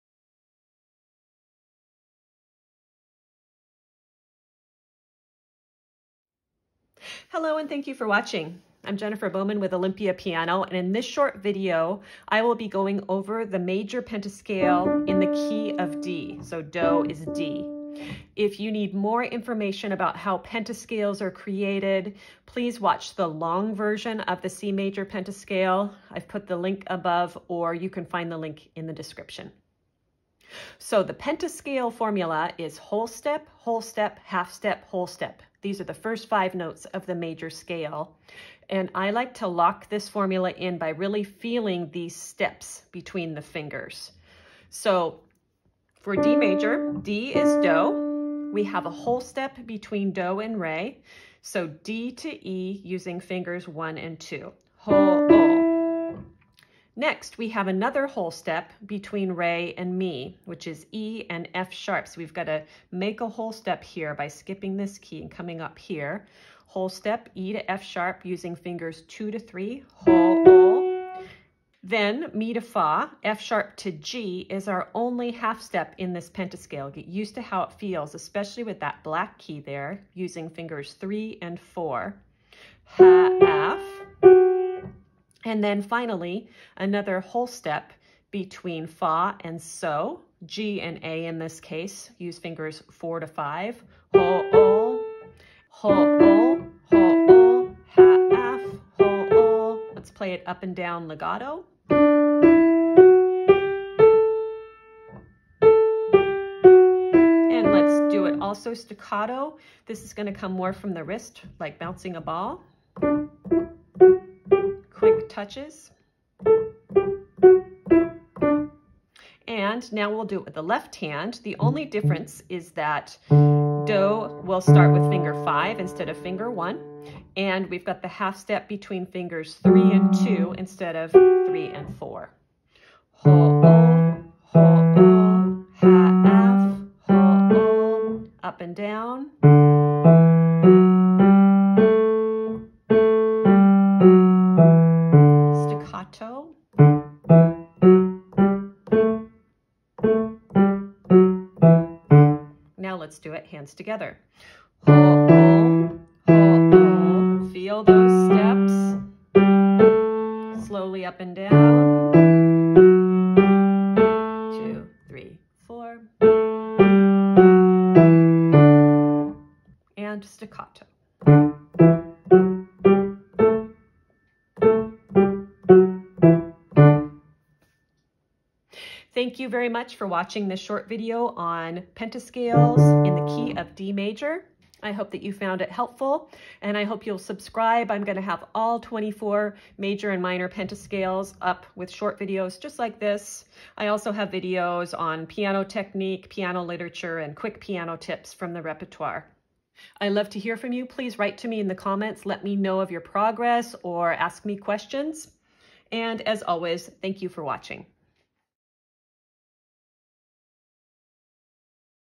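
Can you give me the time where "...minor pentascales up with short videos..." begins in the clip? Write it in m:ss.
3:10.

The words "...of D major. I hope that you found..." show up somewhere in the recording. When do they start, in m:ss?
3:03.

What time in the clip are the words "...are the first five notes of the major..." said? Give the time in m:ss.
0:35.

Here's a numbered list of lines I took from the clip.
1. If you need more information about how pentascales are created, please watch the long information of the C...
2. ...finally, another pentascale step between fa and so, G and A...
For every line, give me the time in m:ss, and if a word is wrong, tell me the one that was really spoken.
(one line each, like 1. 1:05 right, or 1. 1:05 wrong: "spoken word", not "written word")
1. 0:18 wrong: "version", not "information"
2. 1:25 wrong: "whole", not "pentascale".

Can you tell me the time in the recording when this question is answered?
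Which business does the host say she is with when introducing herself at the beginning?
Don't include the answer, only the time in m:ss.
0:09.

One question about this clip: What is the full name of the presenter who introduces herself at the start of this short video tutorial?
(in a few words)
Jennifer Bowman.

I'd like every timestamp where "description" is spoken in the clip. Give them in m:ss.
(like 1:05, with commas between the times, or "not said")
0:28.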